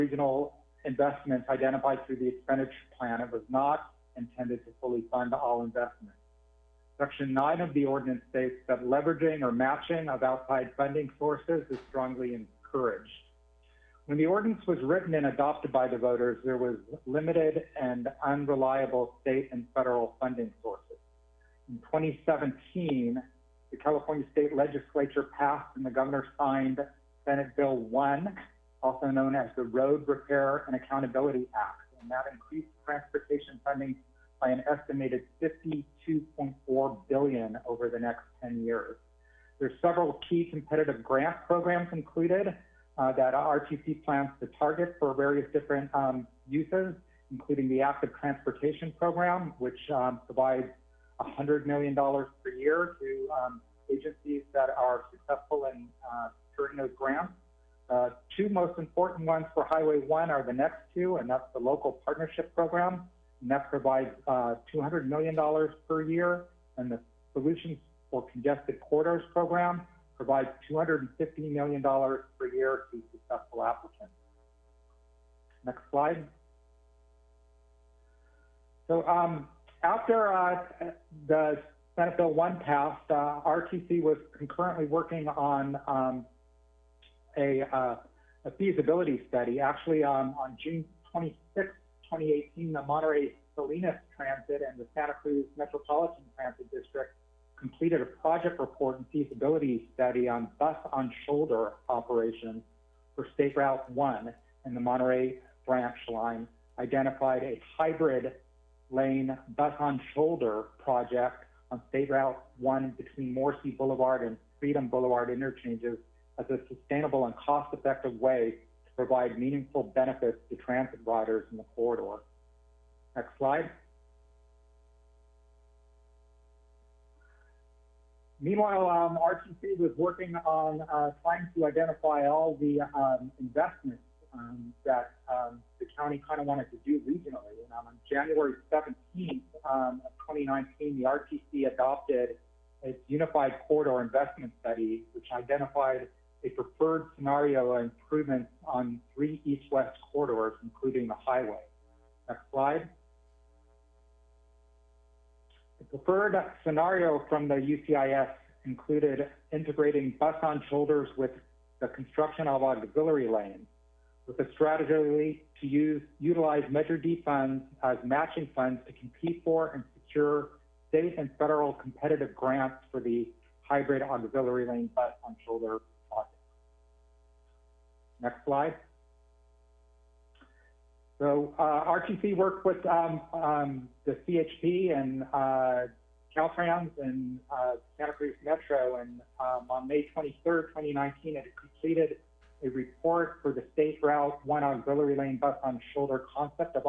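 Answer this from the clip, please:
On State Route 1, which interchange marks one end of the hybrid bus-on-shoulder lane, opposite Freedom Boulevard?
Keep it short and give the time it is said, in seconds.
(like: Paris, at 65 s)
Morrissey Boulevard, at 113 s.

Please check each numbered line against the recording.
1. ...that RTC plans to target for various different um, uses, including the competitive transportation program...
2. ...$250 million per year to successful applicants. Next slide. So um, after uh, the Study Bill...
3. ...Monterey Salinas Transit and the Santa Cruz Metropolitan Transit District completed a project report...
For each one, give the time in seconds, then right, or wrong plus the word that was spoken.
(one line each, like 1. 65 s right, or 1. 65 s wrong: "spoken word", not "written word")
1. 43 s wrong: "active", not "competitive"
2. 70 s wrong: "Senate", not "Study"
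3. 92 s right.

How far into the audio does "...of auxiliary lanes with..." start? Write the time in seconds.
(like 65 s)
162 s.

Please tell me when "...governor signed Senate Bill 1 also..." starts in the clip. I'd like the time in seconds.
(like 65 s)
25 s.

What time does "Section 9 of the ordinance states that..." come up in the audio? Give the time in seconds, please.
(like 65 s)
6 s.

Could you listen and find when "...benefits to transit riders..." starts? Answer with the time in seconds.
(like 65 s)
119 s.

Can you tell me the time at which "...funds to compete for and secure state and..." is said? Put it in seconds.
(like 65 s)
168 s.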